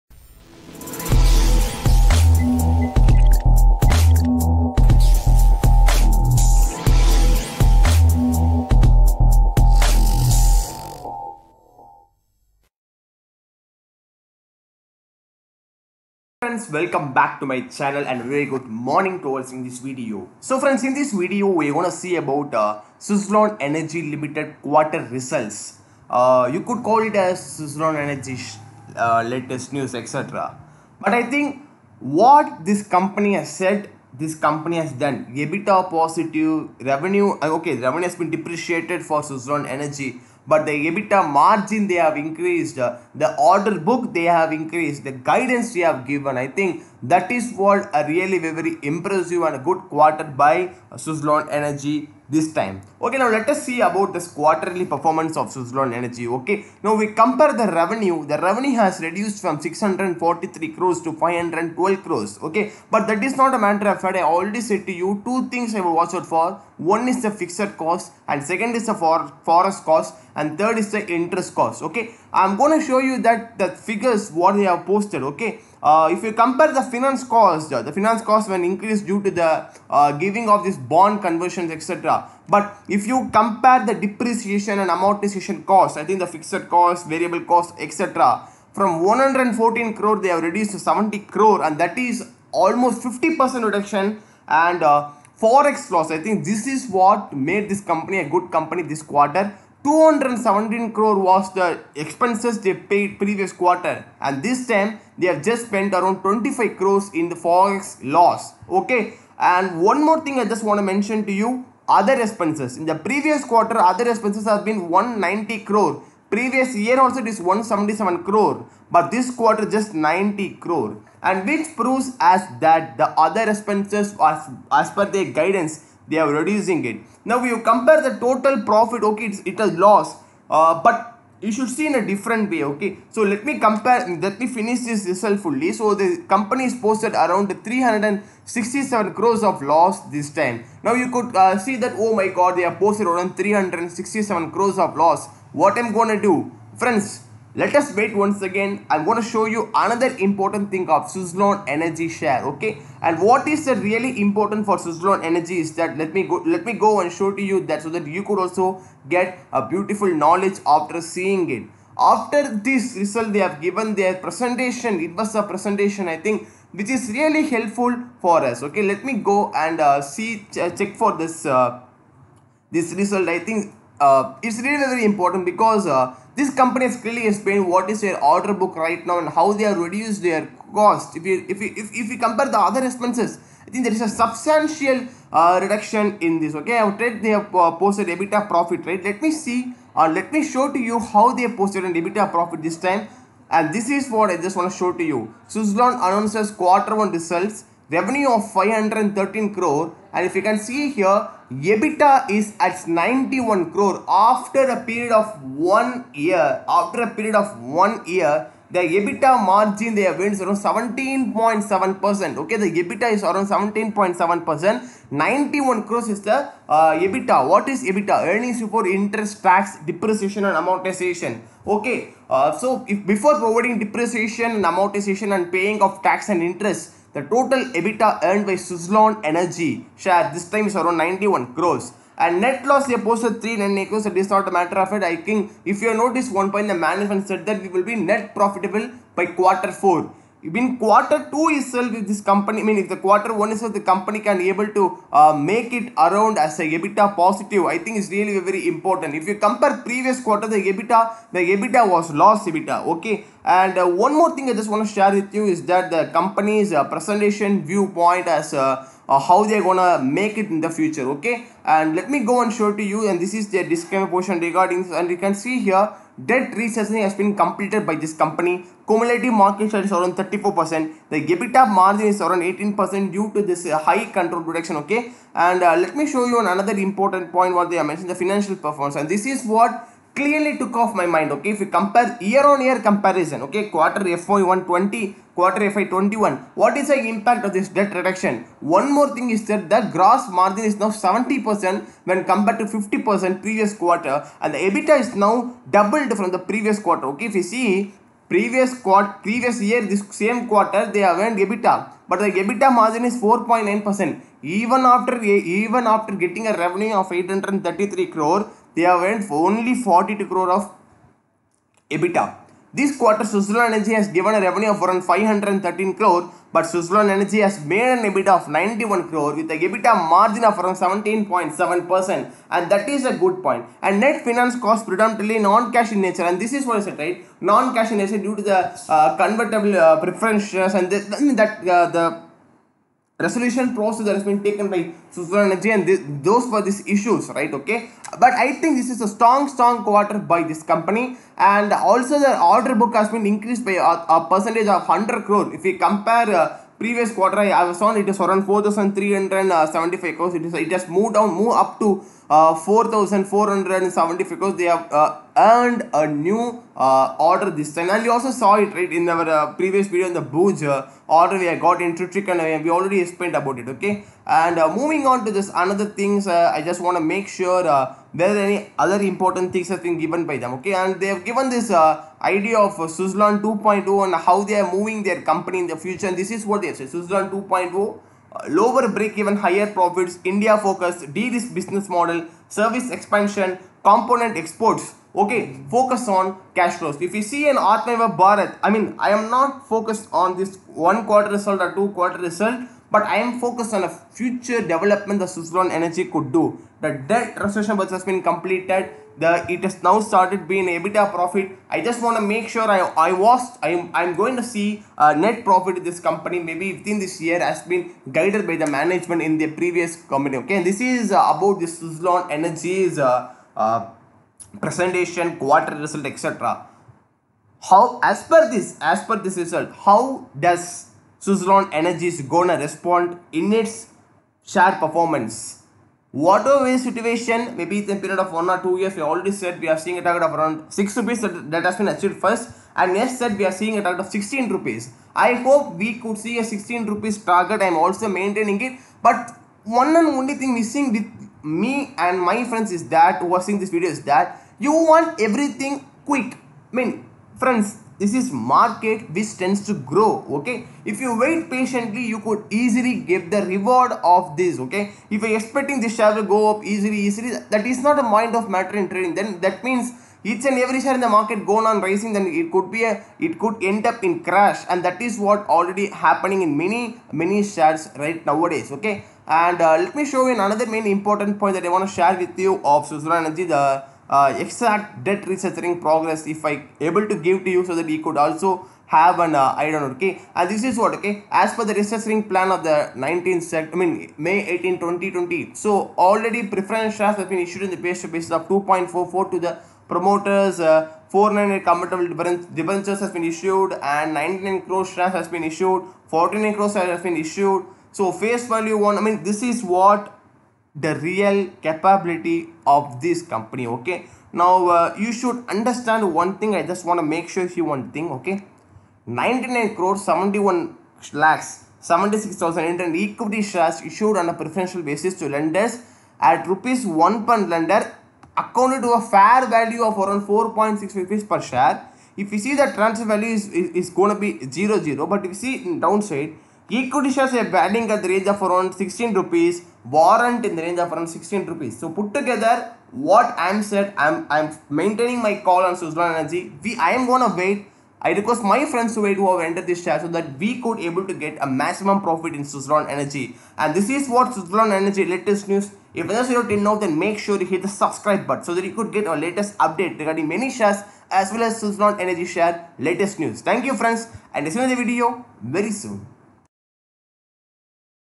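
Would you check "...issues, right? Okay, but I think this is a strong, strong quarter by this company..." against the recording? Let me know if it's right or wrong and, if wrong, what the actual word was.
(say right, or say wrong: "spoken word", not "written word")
right.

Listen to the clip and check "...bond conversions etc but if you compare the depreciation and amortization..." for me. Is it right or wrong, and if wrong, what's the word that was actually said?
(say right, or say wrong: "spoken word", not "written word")
right.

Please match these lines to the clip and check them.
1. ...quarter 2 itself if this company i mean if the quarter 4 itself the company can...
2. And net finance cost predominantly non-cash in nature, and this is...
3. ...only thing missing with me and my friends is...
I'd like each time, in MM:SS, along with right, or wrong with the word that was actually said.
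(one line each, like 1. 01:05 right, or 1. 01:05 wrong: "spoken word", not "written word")
1. 04:00 wrong: "1", not "4"
2. 05:23 right
3. 07:20 right.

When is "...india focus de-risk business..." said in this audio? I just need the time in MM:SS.
06:20.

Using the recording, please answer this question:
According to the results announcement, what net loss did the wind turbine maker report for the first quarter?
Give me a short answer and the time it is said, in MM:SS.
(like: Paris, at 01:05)
399 crores, at 03:53.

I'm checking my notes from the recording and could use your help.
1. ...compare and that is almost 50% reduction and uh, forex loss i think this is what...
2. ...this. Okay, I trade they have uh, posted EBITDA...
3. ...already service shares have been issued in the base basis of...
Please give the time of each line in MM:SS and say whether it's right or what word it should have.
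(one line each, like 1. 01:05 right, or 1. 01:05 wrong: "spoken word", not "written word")
1. 01:31 wrong: "crore", not "compare"
2. 03:06 right
3. 08:05 wrong: "preference", not "service".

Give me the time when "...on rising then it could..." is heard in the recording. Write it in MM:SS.
07:41.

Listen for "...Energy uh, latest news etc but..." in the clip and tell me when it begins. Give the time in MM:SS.
00:27.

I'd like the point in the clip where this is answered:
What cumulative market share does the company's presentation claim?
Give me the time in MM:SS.
04:30.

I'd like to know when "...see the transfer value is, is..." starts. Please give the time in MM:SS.
08:42.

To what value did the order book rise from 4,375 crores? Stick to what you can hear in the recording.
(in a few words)
4475 crores.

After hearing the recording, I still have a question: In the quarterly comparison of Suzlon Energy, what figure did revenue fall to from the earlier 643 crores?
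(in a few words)
512 crores.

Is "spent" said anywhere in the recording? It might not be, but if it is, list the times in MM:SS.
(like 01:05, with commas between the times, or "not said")
01:45.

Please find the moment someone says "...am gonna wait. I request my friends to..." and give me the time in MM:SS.
08:56.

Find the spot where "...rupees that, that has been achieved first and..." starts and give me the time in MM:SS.
07:10.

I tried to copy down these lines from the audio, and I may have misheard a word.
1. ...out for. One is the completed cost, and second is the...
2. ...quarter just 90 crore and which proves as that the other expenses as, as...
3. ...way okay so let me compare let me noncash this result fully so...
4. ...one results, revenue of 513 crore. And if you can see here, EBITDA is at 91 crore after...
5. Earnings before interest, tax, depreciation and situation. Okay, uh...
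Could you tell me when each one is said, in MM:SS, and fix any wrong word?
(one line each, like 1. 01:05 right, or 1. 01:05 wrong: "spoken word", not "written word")
1. 01:06 wrong: "fixed", not "completed"
2. 01:59 right
3. 02:12 wrong: "finish", not "noncash"
4. 03:16 right
5. 03:38 wrong: "amortization", not "situation".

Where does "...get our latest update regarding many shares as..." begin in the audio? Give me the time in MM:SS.
09:08.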